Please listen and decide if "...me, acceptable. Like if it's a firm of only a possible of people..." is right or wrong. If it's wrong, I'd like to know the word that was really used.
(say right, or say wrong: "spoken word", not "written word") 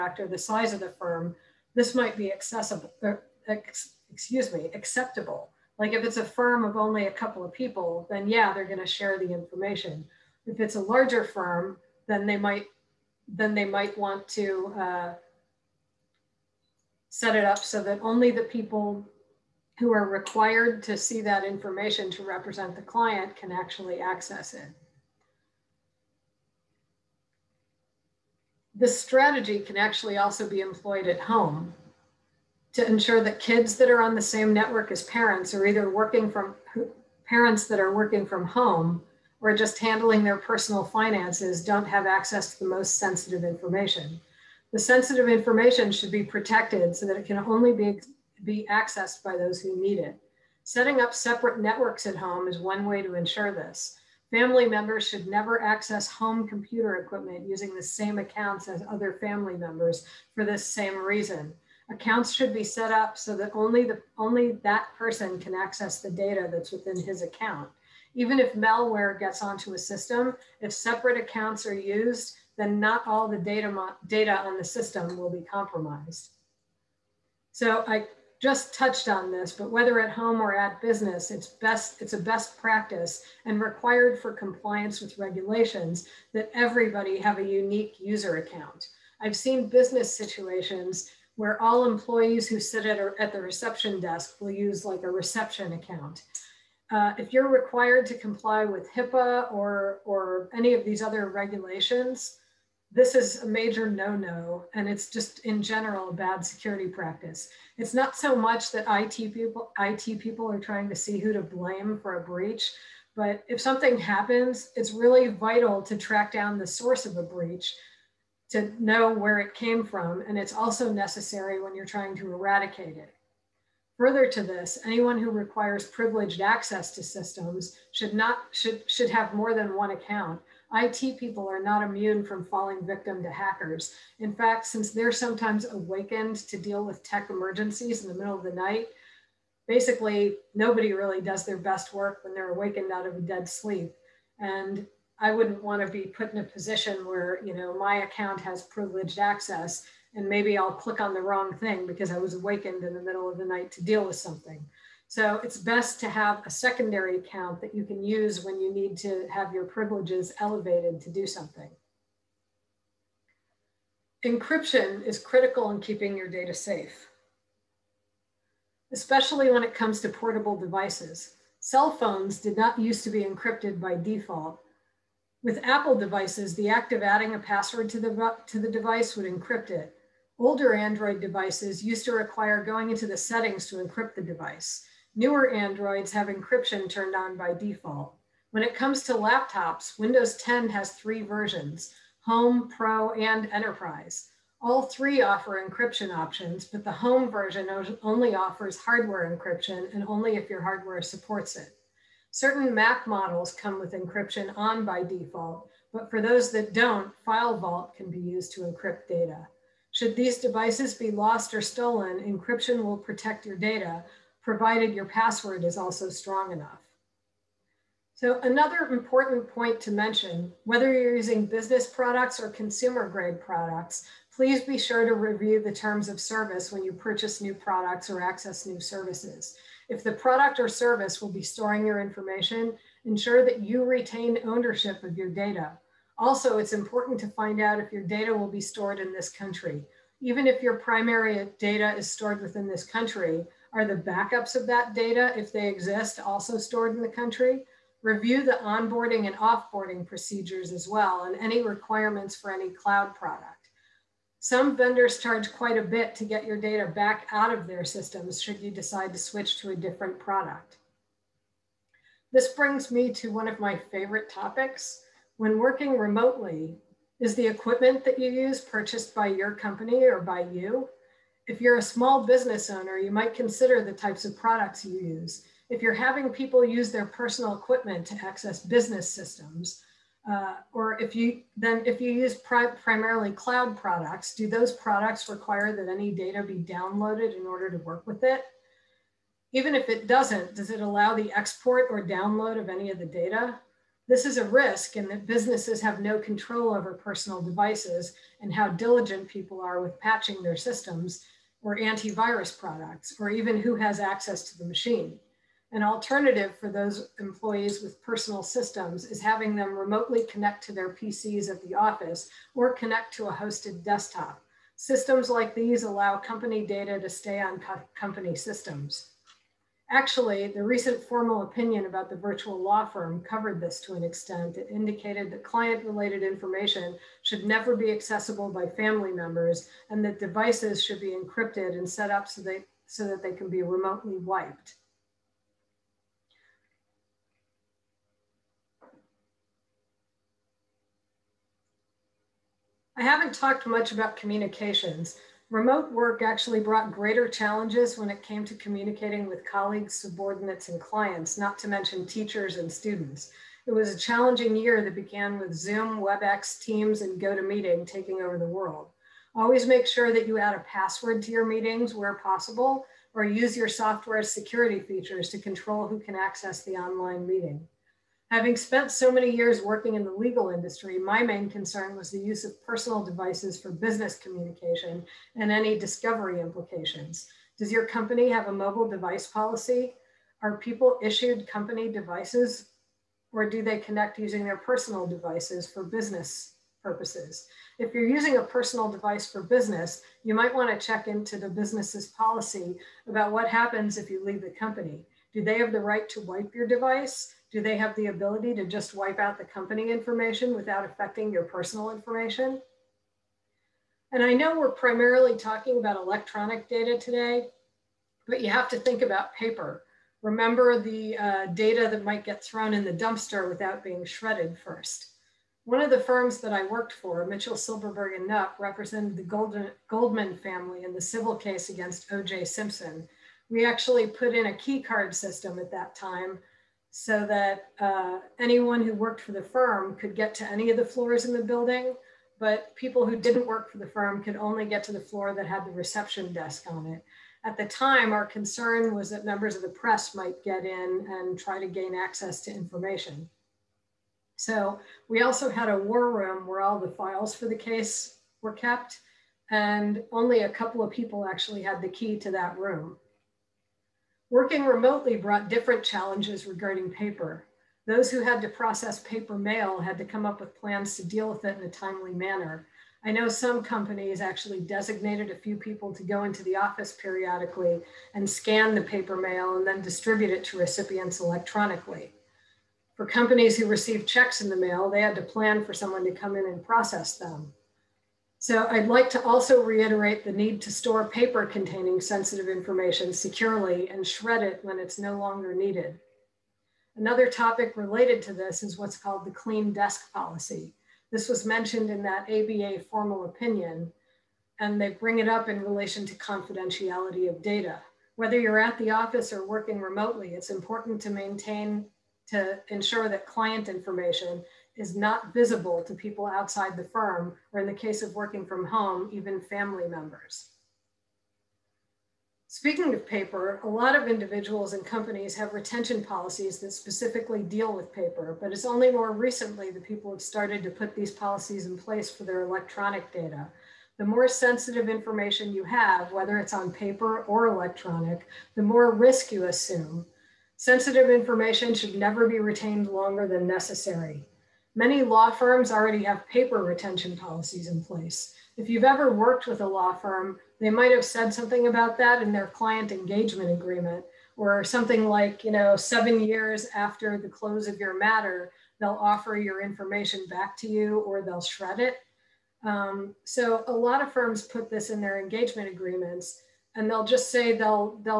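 wrong: "couple", not "possible".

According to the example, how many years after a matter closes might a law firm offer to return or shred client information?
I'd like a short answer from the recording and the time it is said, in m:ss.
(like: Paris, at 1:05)
7, at 9:05.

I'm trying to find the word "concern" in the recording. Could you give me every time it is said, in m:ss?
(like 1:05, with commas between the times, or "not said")
6:11, 7:18.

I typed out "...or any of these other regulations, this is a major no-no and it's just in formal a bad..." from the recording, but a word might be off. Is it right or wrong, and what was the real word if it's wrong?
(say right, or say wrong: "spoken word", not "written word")
wrong: "general", not "formal".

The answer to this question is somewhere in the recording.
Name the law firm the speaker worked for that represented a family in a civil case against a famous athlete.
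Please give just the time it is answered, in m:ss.
6:57.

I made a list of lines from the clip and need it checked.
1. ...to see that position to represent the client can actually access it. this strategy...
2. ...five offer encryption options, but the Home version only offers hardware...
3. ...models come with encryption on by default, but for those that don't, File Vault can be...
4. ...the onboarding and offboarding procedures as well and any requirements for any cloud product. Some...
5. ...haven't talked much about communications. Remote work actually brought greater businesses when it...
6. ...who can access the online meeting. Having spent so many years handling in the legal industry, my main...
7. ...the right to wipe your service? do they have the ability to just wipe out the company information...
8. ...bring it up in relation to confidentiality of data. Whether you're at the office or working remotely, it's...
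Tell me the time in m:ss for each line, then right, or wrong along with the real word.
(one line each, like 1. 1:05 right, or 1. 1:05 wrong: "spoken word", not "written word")
1. 0:20 wrong: "information", not "position"
2. 3:14 wrong: "three", not "five"
3. 3:23 right
4. 4:08 right
5. 5:43 wrong: "challenges", not "businesses"
6. 6:05 wrong: "working", not "handling"
7. 6:35 wrong: "device", not "service"
8. 8:14 right.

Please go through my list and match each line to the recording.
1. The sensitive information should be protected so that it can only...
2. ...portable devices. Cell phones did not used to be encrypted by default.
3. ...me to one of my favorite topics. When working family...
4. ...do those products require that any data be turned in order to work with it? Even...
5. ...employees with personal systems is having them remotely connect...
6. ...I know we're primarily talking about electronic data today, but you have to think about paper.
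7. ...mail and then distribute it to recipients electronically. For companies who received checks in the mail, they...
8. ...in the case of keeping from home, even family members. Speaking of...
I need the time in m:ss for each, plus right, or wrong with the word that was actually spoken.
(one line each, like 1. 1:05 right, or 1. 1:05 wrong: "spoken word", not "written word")
1. 0:44 right
2. 2:50 right
3. 4:22 wrong: "remotely", not "family"
4. 4:44 wrong: "downloaded", not "turned"
5. 5:07 right
6. 6:44 right
7. 7:49 right
8. 8:27 wrong: "working", not "keeping".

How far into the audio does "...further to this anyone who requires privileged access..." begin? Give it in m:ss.
2:03.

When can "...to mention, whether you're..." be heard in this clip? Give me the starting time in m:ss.
3:39.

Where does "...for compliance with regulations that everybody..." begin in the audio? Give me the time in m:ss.
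1:24.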